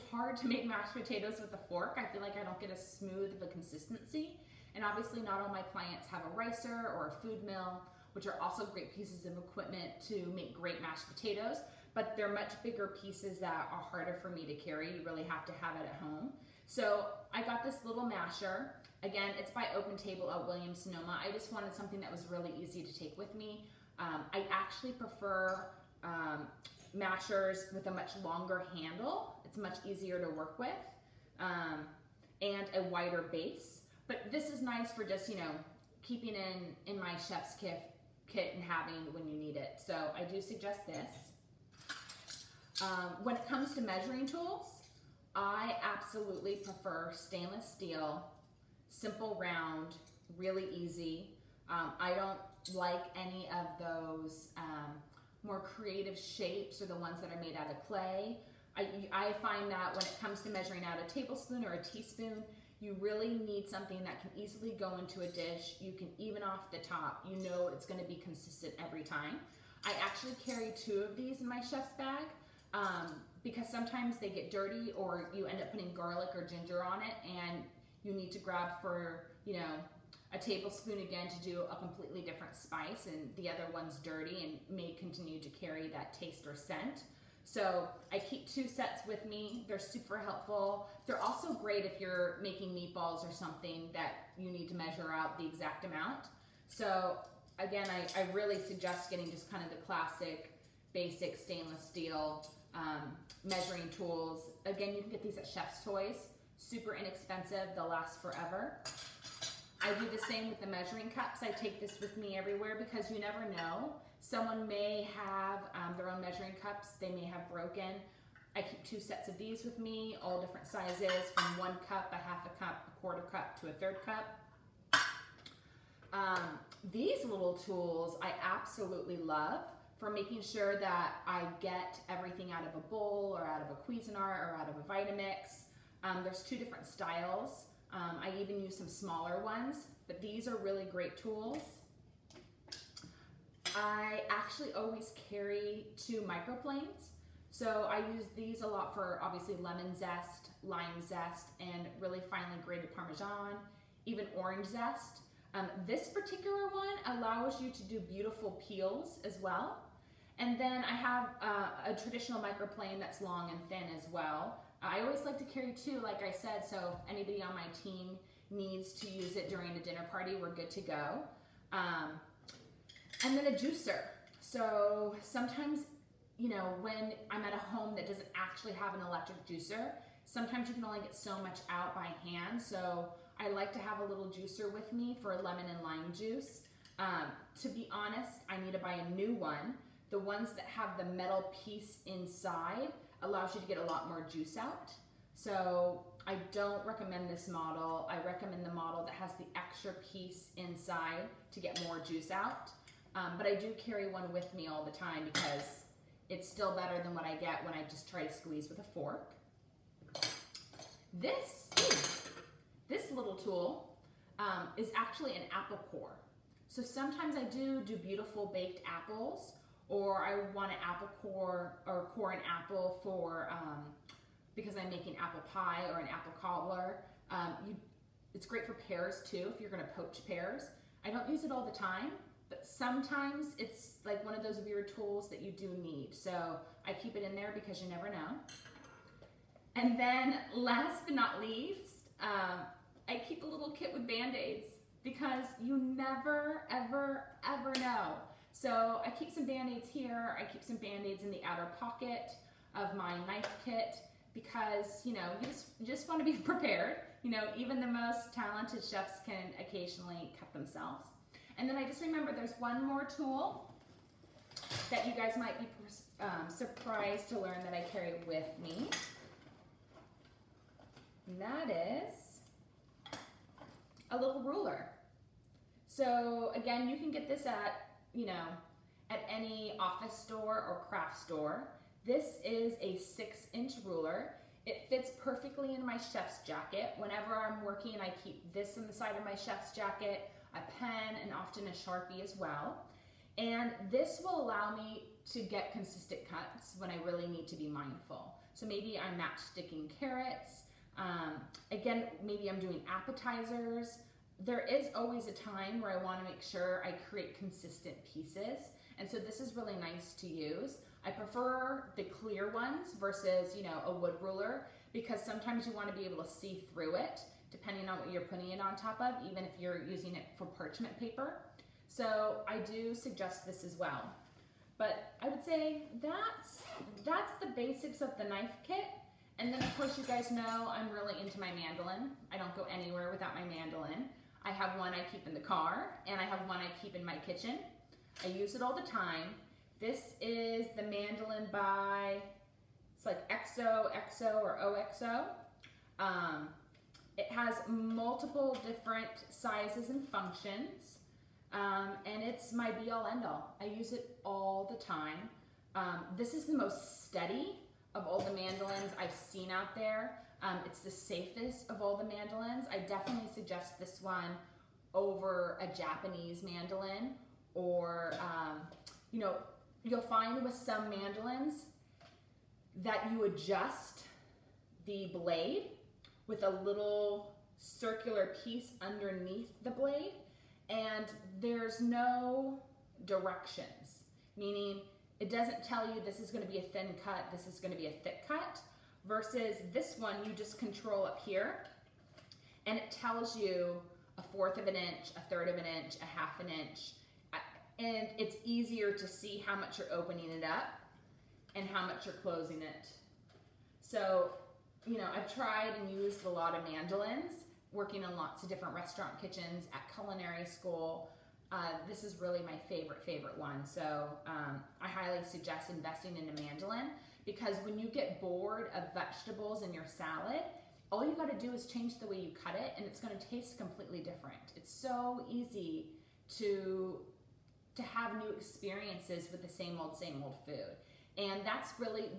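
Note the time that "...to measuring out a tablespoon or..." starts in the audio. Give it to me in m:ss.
1:00.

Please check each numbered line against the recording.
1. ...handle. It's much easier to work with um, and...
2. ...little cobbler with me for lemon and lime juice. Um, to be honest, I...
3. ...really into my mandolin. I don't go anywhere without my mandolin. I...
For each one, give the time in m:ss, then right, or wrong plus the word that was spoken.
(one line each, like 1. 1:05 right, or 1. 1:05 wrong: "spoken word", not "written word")
1. 0:28 right
2. 3:04 wrong: "juicer", not "cobbler"
3. 5:30 right.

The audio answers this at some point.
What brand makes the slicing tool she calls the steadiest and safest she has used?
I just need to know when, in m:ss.
5:44.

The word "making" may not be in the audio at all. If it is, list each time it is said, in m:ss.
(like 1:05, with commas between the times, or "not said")
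1:32, 2:10, 3:44.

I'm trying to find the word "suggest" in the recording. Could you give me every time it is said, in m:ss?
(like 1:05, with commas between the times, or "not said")
0:40, 1:38, 5:22, 6:03, 6:55.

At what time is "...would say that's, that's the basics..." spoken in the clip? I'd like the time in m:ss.
5:25.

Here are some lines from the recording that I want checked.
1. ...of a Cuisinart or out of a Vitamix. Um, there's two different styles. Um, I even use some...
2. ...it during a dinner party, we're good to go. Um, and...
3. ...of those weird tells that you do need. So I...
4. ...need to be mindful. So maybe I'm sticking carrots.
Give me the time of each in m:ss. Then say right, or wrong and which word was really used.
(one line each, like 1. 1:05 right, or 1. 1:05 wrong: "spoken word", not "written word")
1. 2:13 right
2. 2:49 right
3. 3:54 wrong: "tools", not "tells"
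4. 4:57 right.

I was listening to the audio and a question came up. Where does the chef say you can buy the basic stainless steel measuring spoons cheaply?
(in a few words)
Chef's Toys.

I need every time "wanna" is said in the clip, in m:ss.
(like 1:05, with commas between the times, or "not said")
5:06, 5:15.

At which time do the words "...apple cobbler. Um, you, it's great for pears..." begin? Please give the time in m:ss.
3:46.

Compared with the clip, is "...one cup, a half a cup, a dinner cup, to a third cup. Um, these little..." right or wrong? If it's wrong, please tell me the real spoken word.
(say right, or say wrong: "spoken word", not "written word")
wrong: "quarter", not "dinner".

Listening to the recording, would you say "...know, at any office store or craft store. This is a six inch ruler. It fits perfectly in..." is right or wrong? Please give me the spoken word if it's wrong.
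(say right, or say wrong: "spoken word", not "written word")
right.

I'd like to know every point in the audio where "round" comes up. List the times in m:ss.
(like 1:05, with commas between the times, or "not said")
0:49.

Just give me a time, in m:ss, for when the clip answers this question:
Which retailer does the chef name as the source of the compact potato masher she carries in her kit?
0:20.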